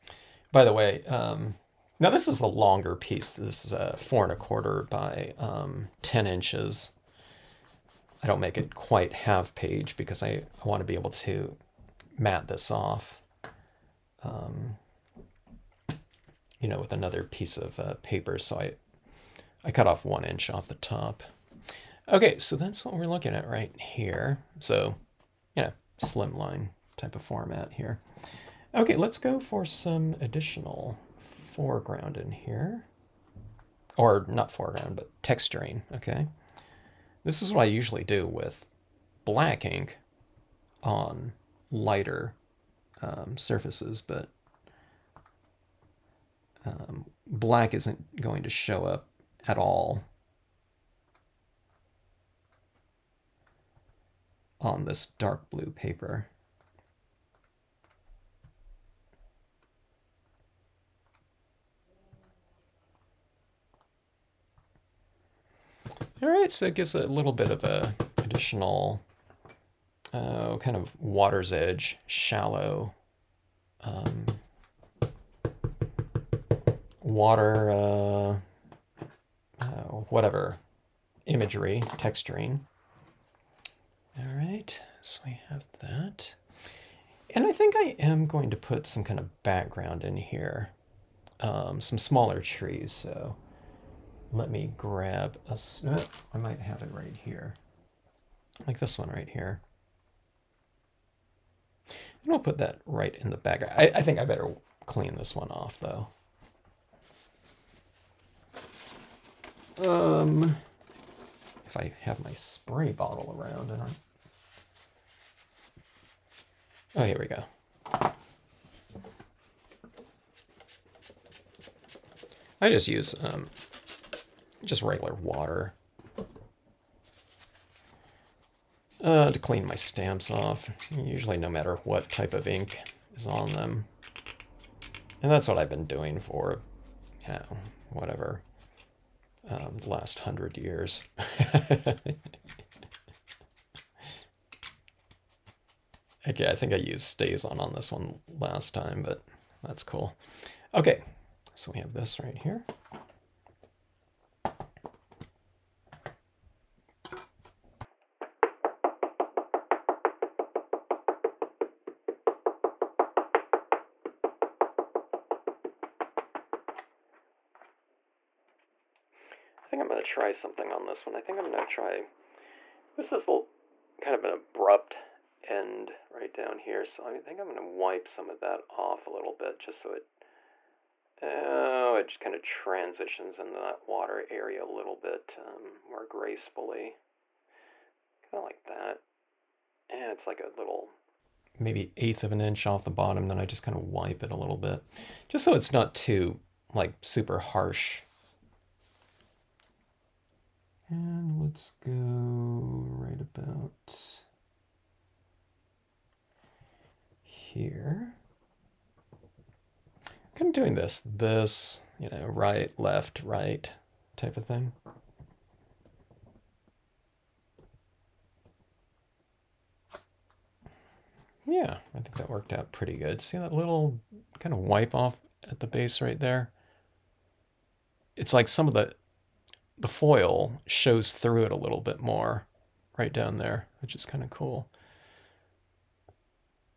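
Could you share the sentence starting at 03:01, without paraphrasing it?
Oh, it just kind of transitions into that water area a little bit um, more gracefully.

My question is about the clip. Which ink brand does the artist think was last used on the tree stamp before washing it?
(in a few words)
StazOn.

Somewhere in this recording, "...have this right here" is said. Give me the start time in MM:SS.
02:31.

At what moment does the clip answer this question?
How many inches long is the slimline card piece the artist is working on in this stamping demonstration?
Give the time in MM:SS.
00:06.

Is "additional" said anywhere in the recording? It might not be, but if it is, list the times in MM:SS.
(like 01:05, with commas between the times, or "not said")
00:30, 01:08.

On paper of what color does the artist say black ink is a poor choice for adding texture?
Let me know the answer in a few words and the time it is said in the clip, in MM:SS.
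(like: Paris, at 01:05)
dark blue, at 00:55.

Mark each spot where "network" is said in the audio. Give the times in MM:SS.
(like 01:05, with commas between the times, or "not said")
not said.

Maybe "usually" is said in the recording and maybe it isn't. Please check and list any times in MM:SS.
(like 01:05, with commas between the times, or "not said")
00:37, 02:10.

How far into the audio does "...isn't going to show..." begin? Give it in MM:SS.
00:47.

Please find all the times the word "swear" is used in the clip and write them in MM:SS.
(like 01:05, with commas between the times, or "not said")
not said.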